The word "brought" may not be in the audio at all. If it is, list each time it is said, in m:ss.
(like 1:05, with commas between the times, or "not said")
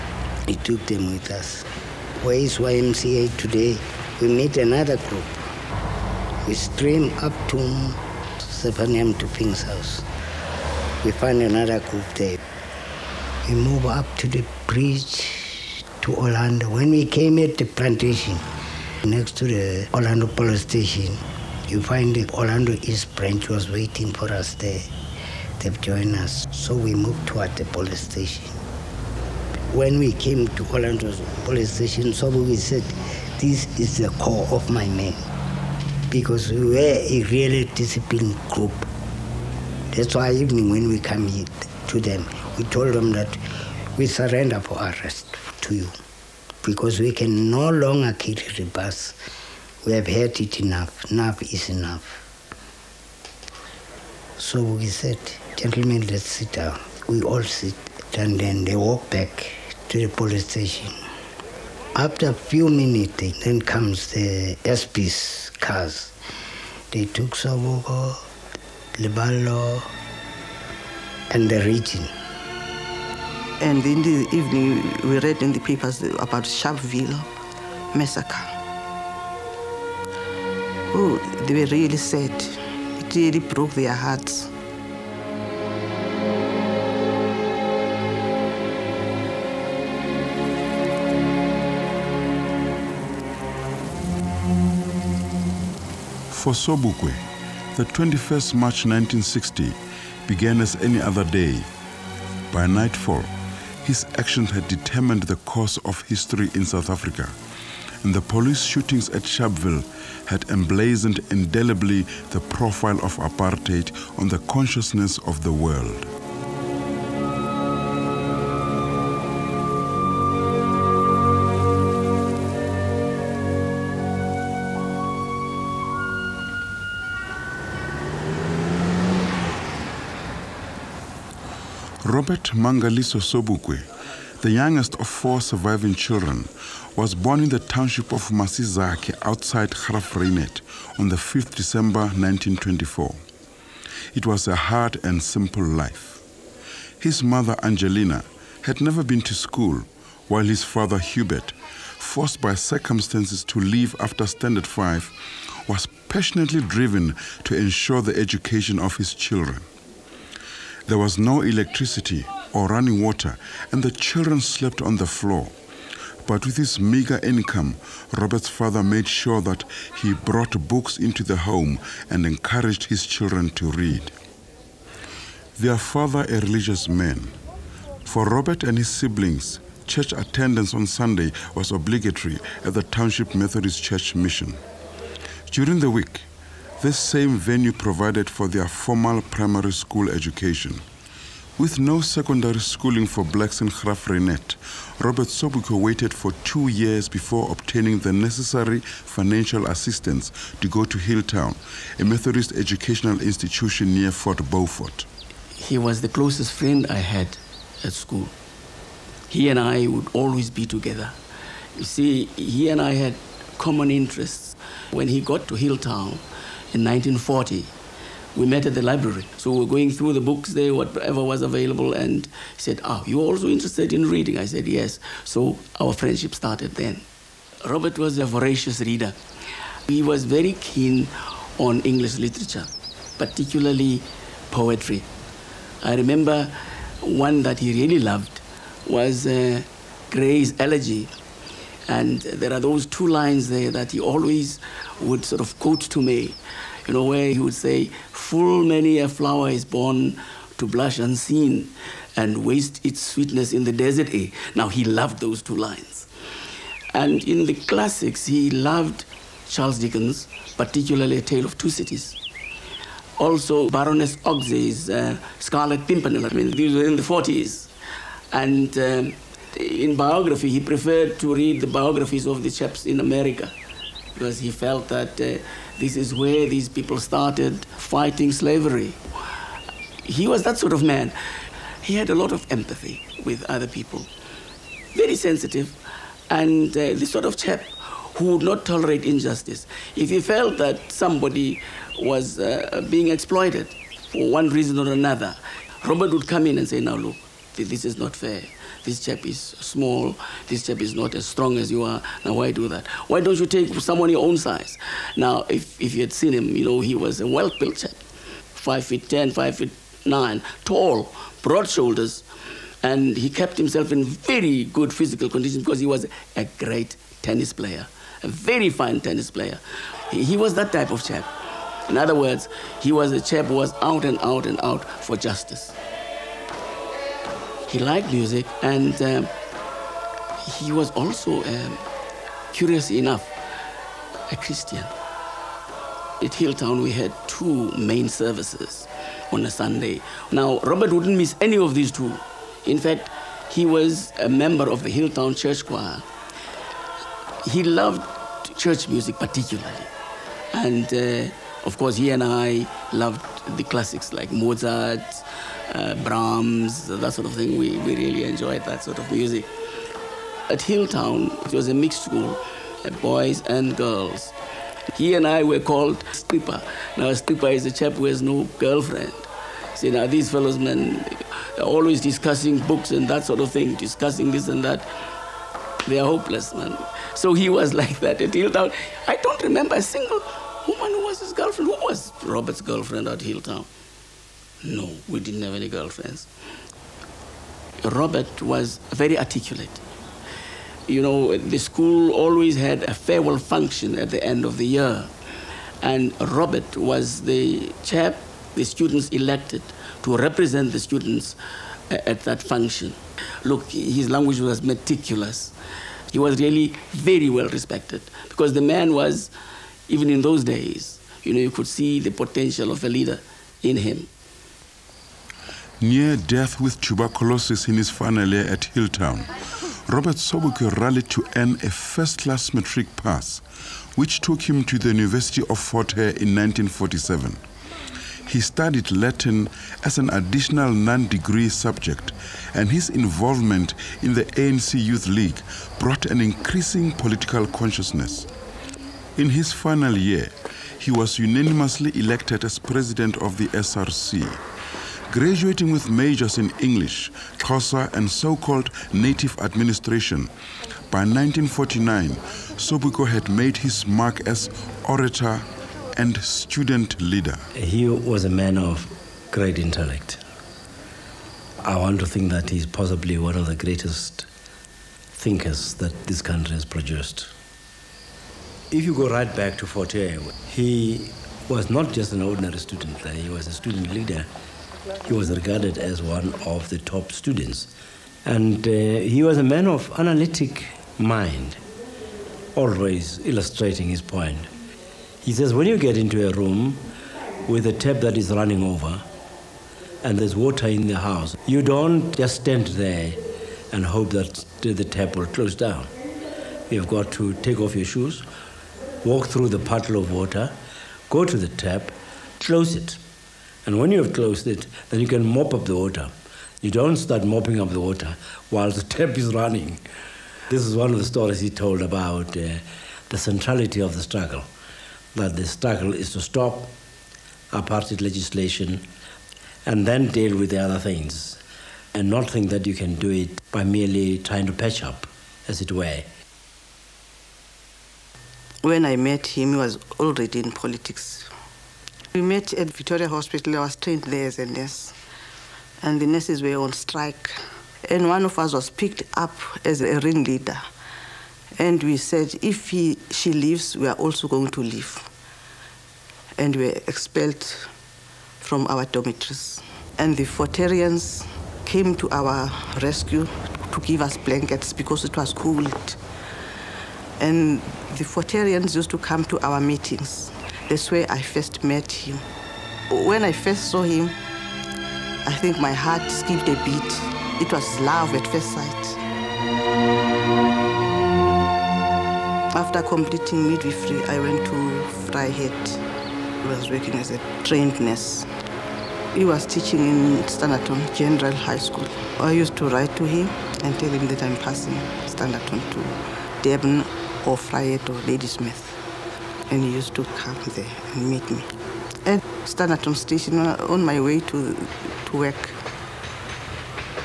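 2:50, 7:15.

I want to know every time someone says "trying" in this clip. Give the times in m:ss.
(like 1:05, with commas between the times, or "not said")
8:44.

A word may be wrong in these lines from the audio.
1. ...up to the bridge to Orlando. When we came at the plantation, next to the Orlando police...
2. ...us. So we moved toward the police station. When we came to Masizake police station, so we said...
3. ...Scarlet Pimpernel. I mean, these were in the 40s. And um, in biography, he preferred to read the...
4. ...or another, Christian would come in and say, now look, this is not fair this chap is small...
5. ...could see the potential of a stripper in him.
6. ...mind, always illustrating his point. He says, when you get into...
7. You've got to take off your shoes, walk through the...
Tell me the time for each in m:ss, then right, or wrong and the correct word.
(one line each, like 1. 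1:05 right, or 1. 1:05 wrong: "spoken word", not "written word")
1. 0:13 right
2. 0:26 wrong: "Orlando", not "Masizake"
3. 4:25 right
4. 4:54 wrong: "Robert", not "Christian"
5. 6:51 wrong: "leader", not "stripper"
6. 8:00 right
7. 8:16 right.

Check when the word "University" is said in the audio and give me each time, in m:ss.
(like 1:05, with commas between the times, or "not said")
7:04.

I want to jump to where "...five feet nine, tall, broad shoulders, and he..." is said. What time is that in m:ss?
5:09.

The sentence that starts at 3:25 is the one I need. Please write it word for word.
He was the closest friend I had at school.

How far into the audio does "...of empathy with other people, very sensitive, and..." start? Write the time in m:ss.
4:42.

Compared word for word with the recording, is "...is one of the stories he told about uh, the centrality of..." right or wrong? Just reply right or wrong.
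right.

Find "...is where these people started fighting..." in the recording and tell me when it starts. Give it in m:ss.
4:35.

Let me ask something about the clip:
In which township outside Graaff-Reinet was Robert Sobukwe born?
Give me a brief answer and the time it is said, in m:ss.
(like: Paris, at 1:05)
Masizake, at 2:18.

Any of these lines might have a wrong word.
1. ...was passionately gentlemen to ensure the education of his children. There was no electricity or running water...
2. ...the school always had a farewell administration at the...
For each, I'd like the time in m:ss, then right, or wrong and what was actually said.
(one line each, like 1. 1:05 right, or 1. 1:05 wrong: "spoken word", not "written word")
1. 2:35 wrong: "driven", not "gentlemen"
2. 6:31 wrong: "function", not "administration".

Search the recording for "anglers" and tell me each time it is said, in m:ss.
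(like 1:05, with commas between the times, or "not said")
not said.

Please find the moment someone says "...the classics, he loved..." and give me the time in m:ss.
4:17.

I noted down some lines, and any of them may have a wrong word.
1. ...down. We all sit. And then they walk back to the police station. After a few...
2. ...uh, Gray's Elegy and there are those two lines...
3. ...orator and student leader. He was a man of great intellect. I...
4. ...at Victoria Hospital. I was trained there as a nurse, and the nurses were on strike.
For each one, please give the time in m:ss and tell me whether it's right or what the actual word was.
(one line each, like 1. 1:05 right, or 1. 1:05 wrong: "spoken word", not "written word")
1. 0:56 right
2. 3:59 right
3. 7:34 right
4. 8:52 right.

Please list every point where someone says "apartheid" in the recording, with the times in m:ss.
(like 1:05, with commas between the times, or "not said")
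1:53, 8:37.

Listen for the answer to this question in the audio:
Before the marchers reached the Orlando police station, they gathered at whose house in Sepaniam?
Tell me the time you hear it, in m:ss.
0:09.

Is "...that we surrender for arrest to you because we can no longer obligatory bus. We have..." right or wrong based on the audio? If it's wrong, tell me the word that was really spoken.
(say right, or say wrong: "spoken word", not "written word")
wrong: "carry", not "obligatory".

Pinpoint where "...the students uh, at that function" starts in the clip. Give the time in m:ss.
6:40.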